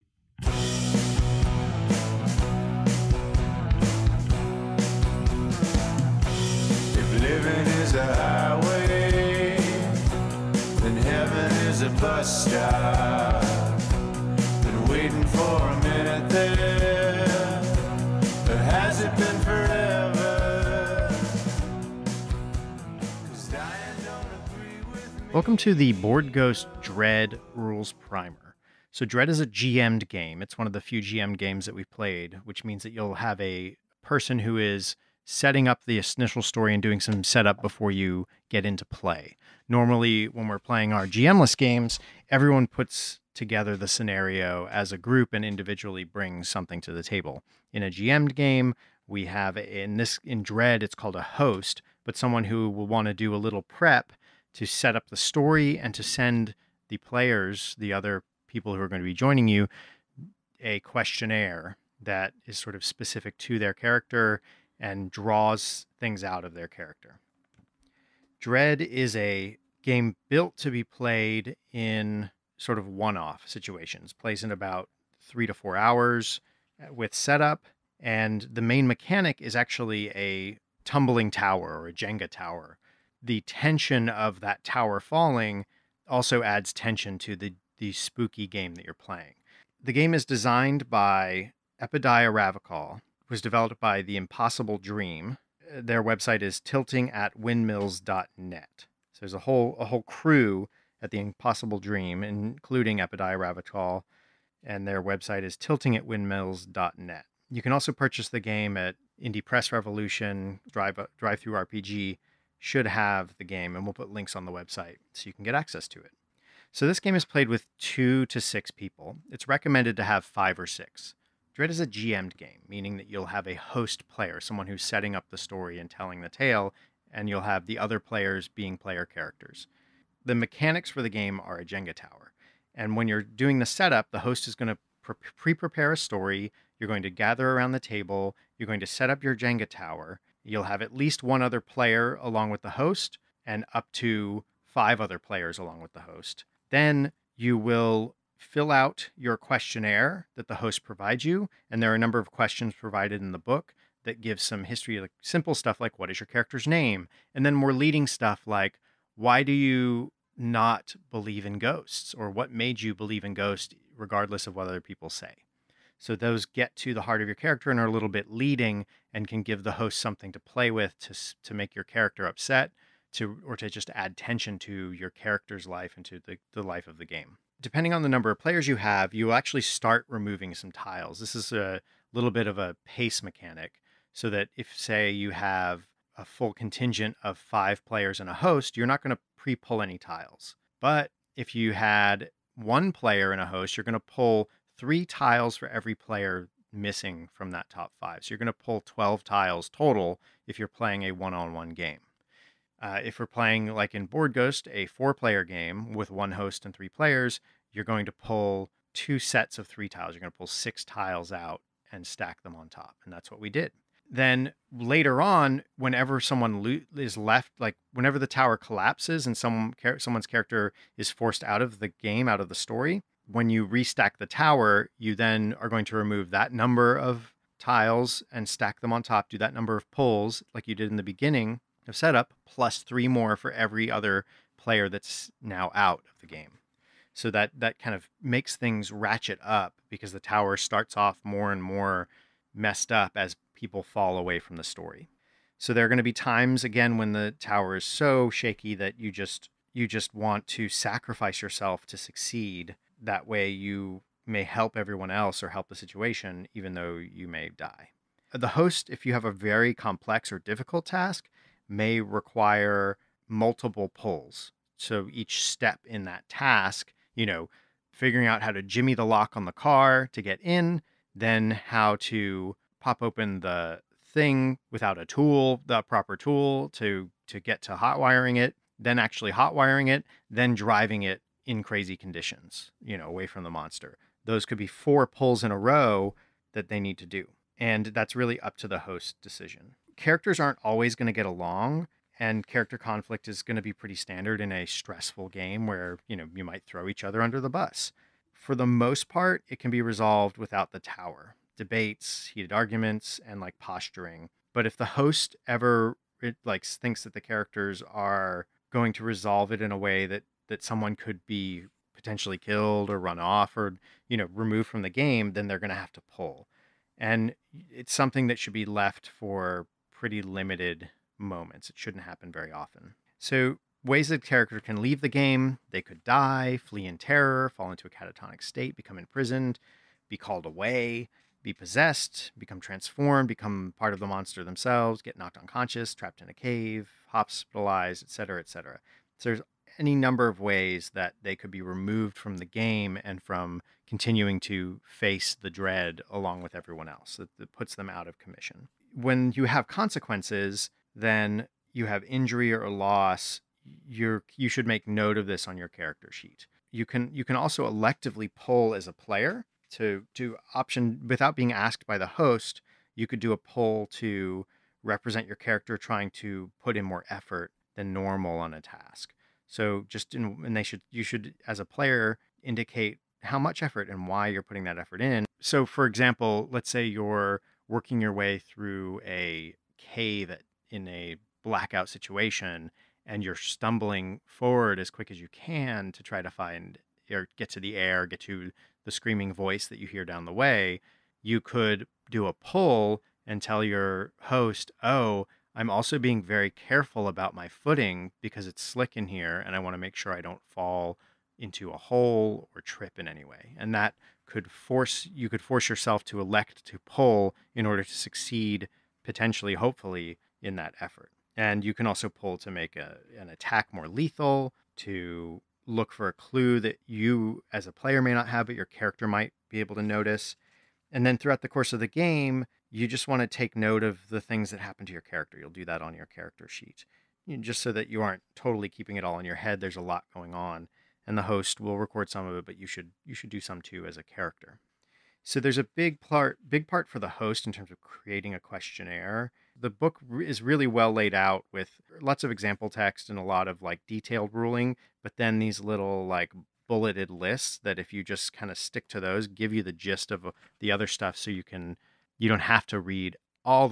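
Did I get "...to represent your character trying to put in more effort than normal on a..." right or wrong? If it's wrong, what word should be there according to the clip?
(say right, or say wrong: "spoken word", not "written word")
right.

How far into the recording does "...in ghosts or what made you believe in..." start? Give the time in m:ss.
2:41.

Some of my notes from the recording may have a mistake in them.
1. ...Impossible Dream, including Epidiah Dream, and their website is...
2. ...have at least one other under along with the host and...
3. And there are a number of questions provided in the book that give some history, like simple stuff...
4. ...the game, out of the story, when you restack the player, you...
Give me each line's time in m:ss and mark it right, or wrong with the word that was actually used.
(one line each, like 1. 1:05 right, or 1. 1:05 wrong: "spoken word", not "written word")
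1. 1:41 wrong: "Ravachol", not "Dream"
2. 2:20 wrong: "player", not "under"
3. 2:31 right
4. 3:41 wrong: "tower", not "player".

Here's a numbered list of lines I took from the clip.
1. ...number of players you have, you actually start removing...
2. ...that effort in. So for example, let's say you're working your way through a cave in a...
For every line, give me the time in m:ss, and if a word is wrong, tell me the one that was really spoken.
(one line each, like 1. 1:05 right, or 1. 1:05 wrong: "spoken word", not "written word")
1. 2:58 right
2. 6:14 right.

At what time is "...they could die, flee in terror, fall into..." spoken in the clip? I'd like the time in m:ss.
5:25.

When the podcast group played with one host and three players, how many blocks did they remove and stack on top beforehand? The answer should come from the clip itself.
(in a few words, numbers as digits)
6.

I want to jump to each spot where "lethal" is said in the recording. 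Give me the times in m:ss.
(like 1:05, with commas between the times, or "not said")
6:53.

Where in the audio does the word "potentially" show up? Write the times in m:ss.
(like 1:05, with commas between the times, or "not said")
5:11, 6:49.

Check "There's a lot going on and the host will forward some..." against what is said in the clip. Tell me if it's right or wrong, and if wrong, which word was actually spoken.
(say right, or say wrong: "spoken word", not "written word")
wrong: "record", not "forward".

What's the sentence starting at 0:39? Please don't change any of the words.
Normally, when we're playing our GMless games, everyone puts together the scenario as a group and individually brings something to the table.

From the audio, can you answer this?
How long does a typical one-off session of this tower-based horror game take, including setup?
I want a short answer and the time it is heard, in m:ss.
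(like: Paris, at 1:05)
3 to 4 hours, at 1:15.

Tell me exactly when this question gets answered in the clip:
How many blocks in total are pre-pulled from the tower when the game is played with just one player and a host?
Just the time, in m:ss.
3:18.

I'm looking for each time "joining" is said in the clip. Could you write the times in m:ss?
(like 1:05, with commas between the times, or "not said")
0:59.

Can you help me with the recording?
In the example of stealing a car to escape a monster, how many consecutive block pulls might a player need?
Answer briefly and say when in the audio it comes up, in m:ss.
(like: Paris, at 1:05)
4, at 4:44.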